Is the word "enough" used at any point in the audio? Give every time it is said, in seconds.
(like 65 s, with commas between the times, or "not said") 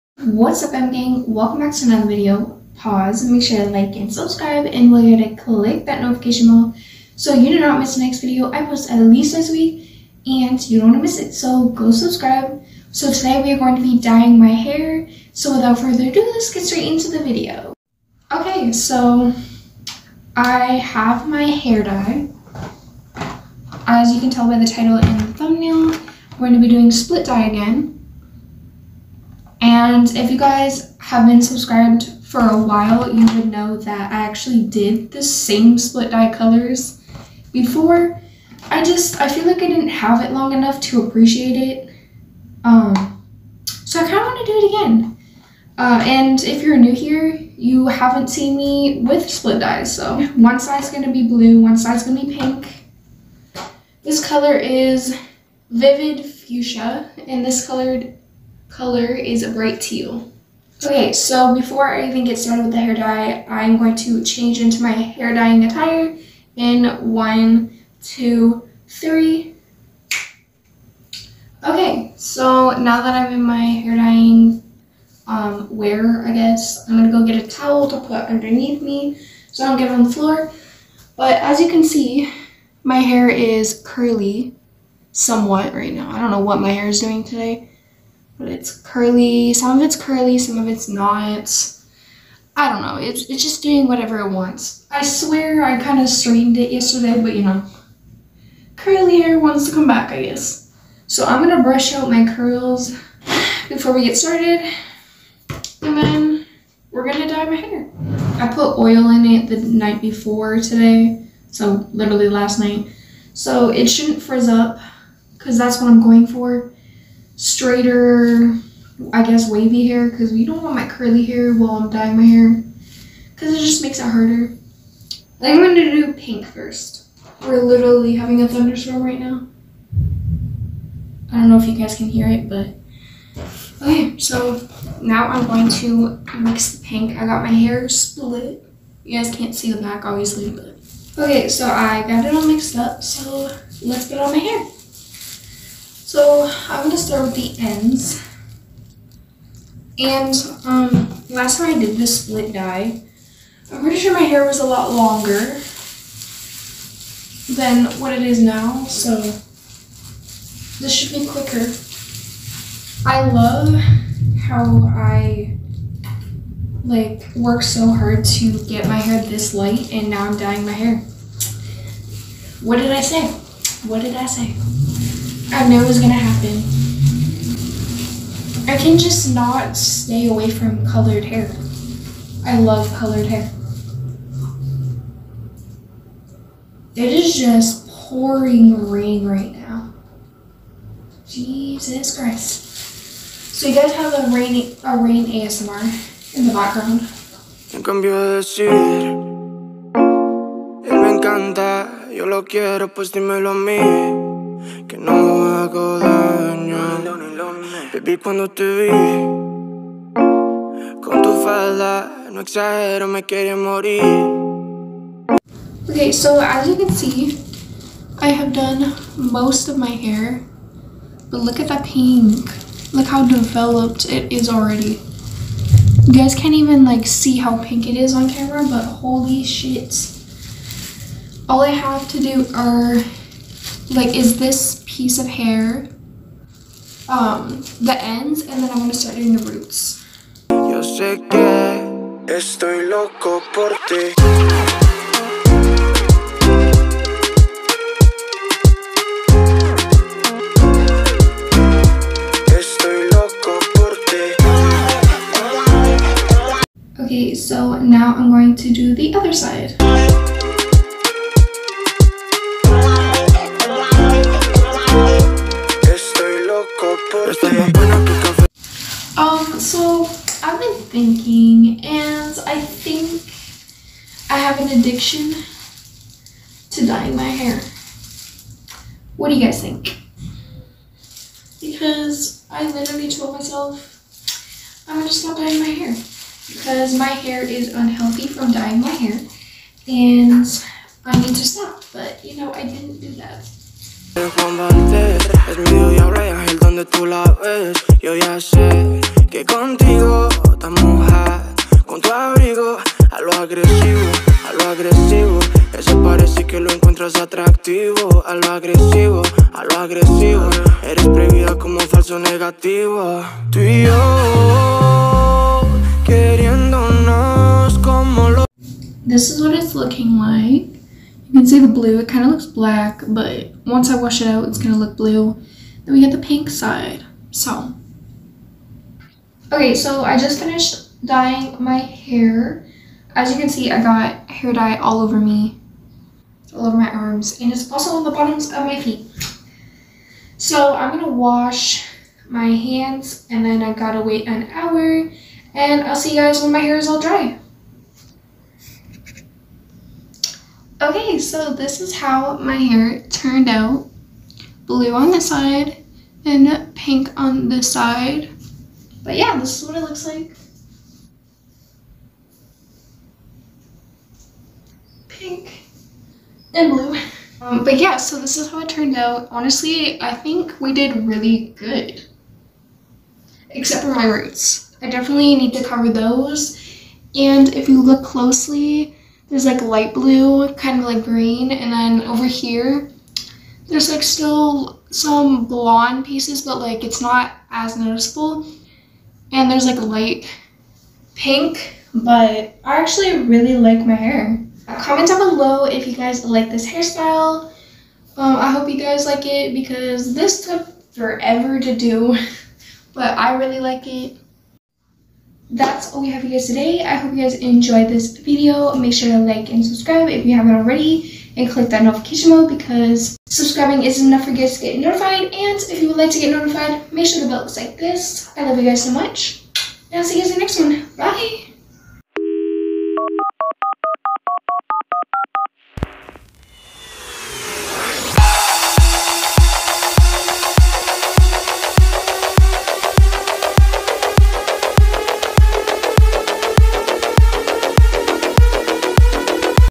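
40 s, 414 s.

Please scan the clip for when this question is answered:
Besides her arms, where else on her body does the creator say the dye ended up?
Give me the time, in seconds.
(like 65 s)
338 s.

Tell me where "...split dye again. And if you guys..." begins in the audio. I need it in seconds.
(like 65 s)
26 s.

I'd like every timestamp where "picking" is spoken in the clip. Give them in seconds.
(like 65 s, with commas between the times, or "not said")
not said.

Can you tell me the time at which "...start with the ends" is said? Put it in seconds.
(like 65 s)
146 s.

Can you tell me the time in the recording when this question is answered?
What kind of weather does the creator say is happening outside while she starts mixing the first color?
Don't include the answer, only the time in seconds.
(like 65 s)
128 s.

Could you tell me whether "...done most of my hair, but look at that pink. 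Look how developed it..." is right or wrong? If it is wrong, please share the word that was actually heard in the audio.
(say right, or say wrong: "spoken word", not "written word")
right.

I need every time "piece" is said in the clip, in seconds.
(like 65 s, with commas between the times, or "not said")
234 s, 386 s.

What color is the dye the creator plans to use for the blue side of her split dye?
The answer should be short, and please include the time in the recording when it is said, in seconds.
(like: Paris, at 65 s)
bright teal, at 59 s.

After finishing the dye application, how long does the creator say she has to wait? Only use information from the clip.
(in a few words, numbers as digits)
an hour.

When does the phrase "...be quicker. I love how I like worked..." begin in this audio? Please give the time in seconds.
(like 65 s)
161 s.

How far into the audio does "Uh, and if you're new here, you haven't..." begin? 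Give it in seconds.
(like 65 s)
45 s.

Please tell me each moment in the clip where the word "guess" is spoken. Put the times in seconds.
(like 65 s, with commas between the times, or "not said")
76 s, 100 s, 119 s.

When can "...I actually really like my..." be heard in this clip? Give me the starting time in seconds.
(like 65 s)
392 s.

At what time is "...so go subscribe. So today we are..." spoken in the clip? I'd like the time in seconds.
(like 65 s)
11 s.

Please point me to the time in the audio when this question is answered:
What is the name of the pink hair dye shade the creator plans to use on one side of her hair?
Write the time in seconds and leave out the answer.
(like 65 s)
55 s.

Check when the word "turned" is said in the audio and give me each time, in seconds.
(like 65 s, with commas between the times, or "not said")
353 s, 368 s.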